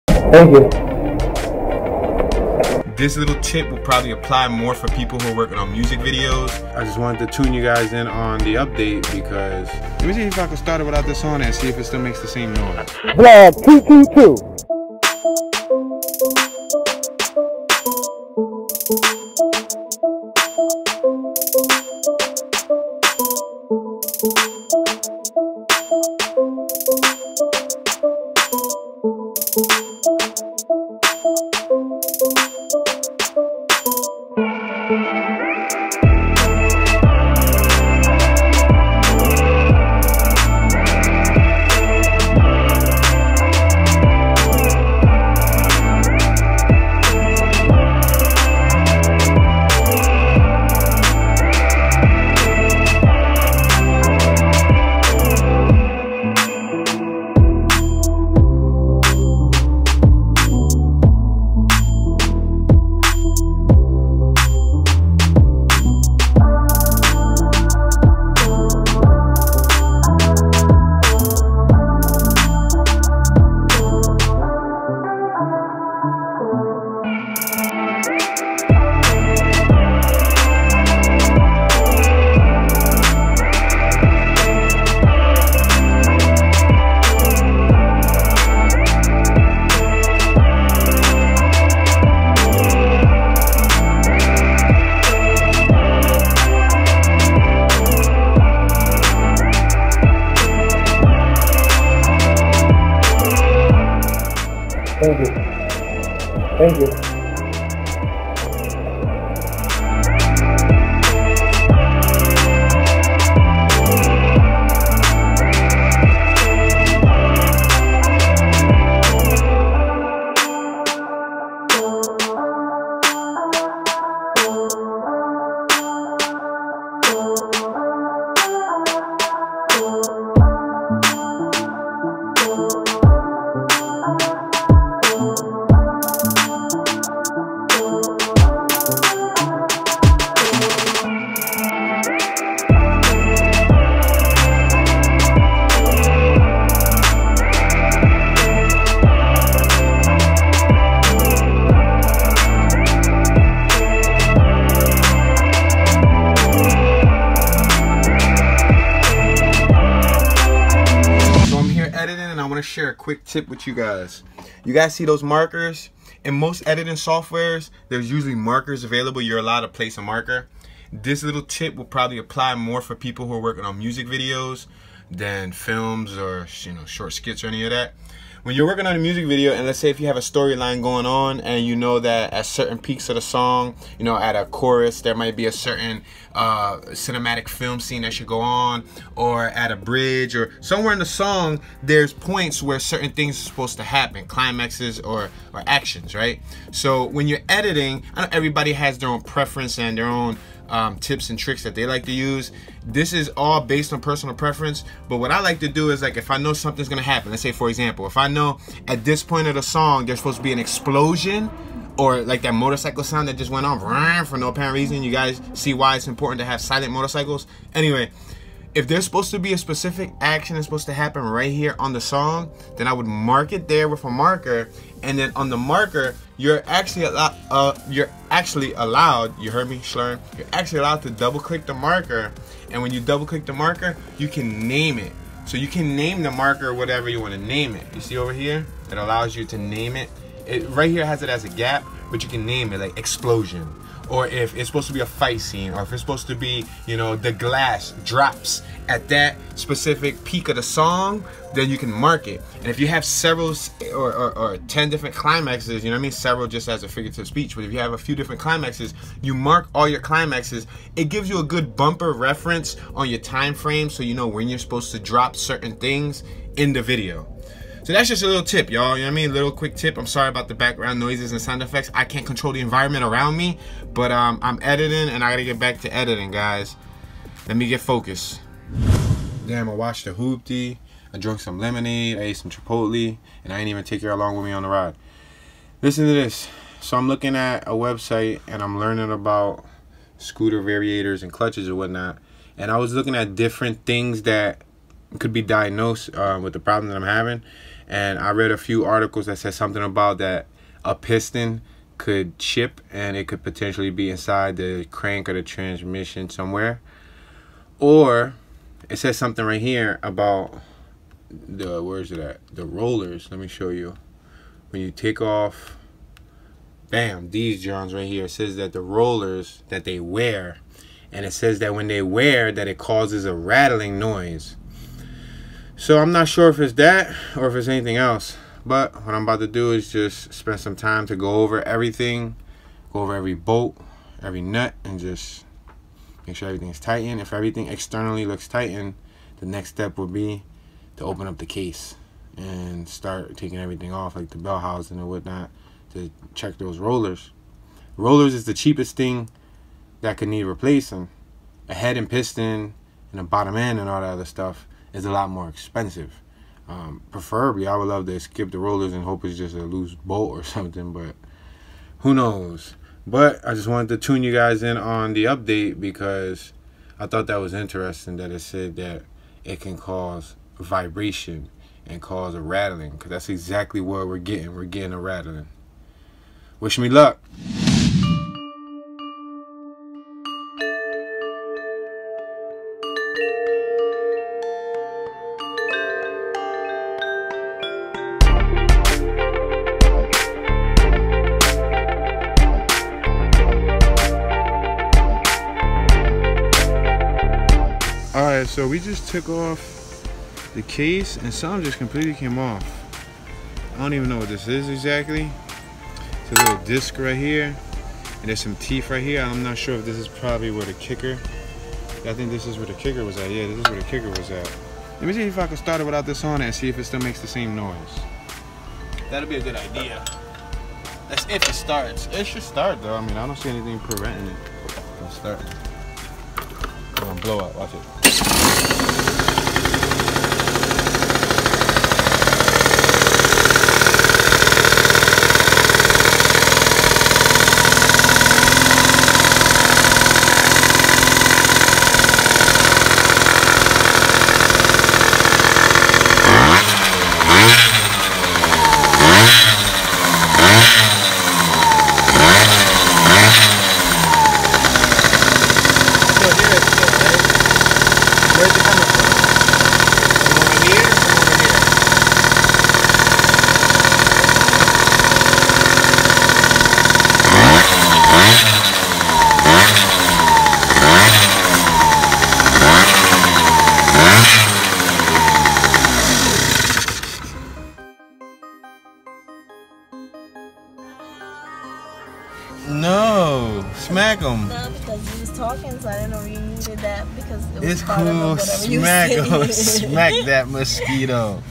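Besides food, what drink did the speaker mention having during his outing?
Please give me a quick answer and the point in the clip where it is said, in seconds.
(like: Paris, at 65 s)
lemonade, at 281 s.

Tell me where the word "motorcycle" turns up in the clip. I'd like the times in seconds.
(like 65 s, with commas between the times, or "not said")
212 s, 216 s.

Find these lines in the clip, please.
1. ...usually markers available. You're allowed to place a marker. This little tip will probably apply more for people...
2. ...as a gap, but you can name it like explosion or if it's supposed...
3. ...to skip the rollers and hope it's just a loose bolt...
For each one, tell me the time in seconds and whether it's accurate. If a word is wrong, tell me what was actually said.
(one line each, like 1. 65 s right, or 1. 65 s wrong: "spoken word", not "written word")
1. 168 s right
2. 241 s right
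3. 358 s right.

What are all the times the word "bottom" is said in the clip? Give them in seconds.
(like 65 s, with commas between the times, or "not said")
353 s.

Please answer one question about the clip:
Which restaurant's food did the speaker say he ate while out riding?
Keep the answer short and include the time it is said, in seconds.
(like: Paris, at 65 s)
Chipotle, at 282 s.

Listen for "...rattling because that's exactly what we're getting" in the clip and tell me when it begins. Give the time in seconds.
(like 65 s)
372 s.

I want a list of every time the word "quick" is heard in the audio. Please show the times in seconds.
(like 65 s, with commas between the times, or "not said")
162 s, 269 s.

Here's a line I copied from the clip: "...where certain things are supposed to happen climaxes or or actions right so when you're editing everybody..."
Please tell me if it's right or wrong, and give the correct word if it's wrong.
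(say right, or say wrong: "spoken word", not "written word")
right.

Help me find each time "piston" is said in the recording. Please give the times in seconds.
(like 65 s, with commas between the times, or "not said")
300 s, 352 s.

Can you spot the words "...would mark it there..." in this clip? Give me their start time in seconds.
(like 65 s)
222 s.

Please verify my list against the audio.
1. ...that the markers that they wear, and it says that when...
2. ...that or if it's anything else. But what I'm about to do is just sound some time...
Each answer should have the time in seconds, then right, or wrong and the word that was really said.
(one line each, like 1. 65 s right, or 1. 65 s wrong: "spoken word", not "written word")
1. 318 s wrong: "rollers", not "markers"
2. 326 s wrong: "spend", not "sound".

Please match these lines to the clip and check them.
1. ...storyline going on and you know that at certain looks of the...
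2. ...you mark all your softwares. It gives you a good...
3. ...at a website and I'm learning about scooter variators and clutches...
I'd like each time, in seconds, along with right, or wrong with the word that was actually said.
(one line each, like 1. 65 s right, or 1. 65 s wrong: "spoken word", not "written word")
1. 180 s wrong: "peaks", not "looks"
2. 259 s wrong: "climaxes", not "softwares"
3. 287 s right.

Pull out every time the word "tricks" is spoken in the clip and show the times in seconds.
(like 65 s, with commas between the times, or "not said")
201 s.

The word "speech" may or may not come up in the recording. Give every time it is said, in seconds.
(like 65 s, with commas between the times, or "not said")
257 s.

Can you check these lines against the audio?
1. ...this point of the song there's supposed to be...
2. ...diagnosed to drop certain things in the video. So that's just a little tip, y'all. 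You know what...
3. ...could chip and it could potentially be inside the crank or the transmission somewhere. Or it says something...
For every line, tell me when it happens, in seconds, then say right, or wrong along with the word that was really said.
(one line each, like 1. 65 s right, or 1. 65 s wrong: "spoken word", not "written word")
1. 209 s right
2. 264 s wrong: "supposed", not "diagnosed"
3. 301 s right.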